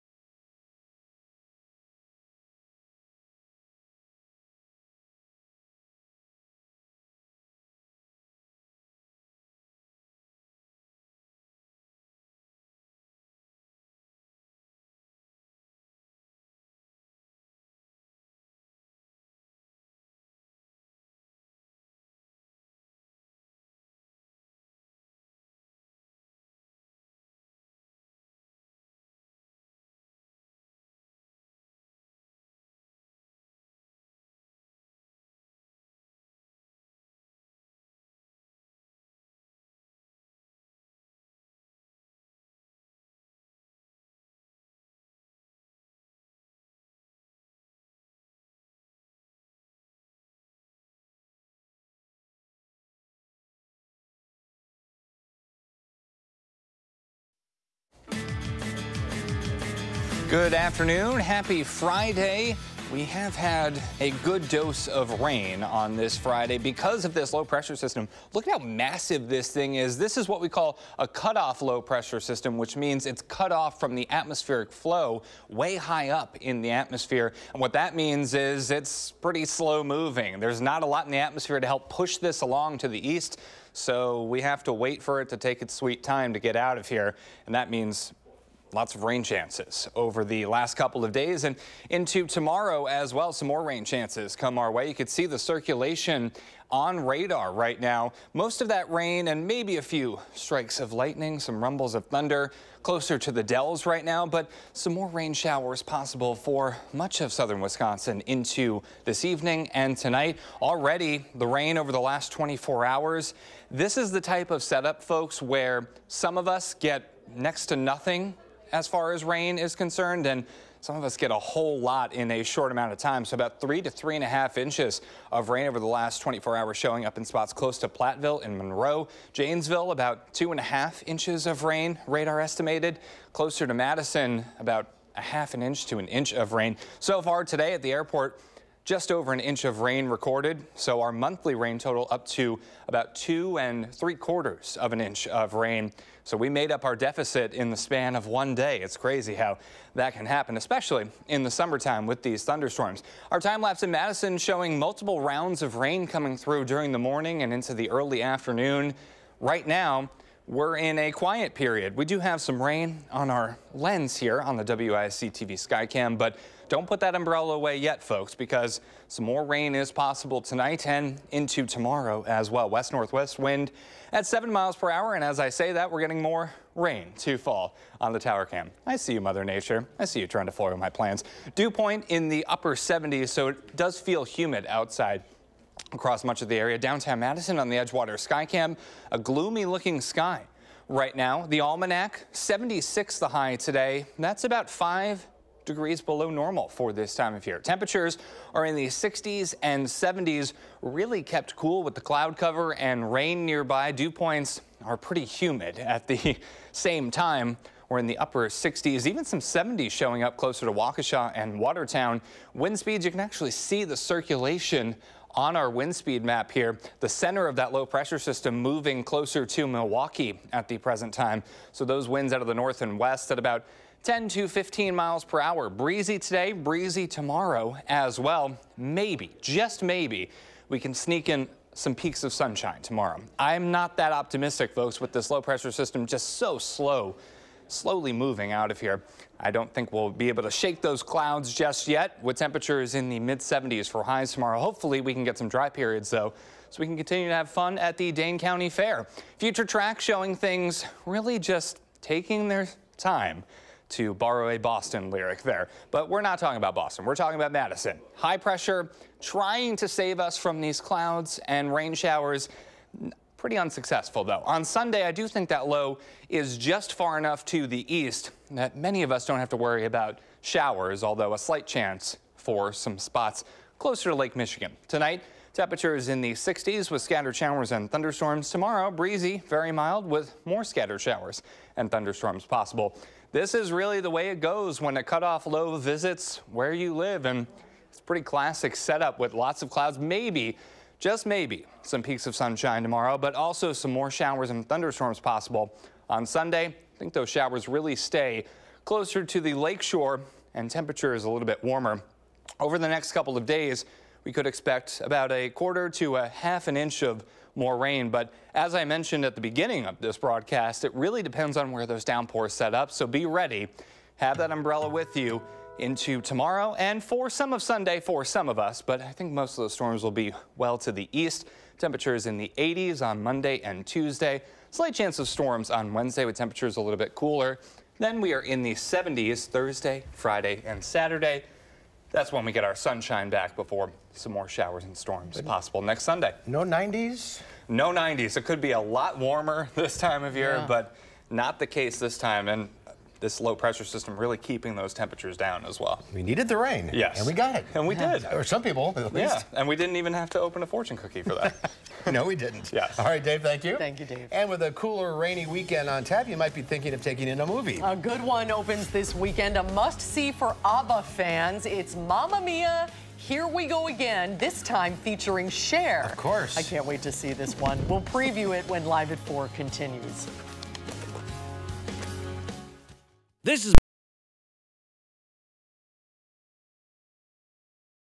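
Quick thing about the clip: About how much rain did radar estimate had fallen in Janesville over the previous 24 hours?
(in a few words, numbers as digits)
2.5 inches.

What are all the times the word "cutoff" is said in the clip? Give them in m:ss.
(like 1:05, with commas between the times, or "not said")
1:11, 4:45.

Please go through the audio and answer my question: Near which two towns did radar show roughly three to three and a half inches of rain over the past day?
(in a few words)
Platteville and Monroe.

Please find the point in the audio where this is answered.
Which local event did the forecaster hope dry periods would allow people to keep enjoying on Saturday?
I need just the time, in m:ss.
4:08.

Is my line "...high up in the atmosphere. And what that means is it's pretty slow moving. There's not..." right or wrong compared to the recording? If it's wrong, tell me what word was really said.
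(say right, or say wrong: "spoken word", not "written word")
right.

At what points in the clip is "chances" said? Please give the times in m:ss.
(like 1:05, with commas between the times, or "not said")
1:29, 1:33, 4:31, 5:24.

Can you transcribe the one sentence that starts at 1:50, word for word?
Already the rain over the last 24 hours.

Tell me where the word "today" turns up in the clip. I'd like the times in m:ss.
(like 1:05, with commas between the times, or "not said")
2:17, 3:13, 3:46.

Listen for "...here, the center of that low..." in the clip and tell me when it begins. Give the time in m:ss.
3:36.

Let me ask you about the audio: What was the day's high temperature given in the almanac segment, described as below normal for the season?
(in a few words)
76.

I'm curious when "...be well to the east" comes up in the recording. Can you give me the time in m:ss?
5:20.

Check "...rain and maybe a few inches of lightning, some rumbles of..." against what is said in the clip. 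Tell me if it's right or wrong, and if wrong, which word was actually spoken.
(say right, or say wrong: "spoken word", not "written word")
wrong: "strikes", not "inches".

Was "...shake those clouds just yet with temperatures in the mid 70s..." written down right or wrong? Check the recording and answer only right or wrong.
right.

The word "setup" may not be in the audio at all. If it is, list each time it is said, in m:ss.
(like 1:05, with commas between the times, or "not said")
1:54, 4:48.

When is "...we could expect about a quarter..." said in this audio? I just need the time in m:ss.
5:04.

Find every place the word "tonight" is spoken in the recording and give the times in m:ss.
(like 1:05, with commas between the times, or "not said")
1:49, 2:50, 4:34.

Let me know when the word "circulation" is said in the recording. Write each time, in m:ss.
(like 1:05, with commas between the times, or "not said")
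1:35, 3:33.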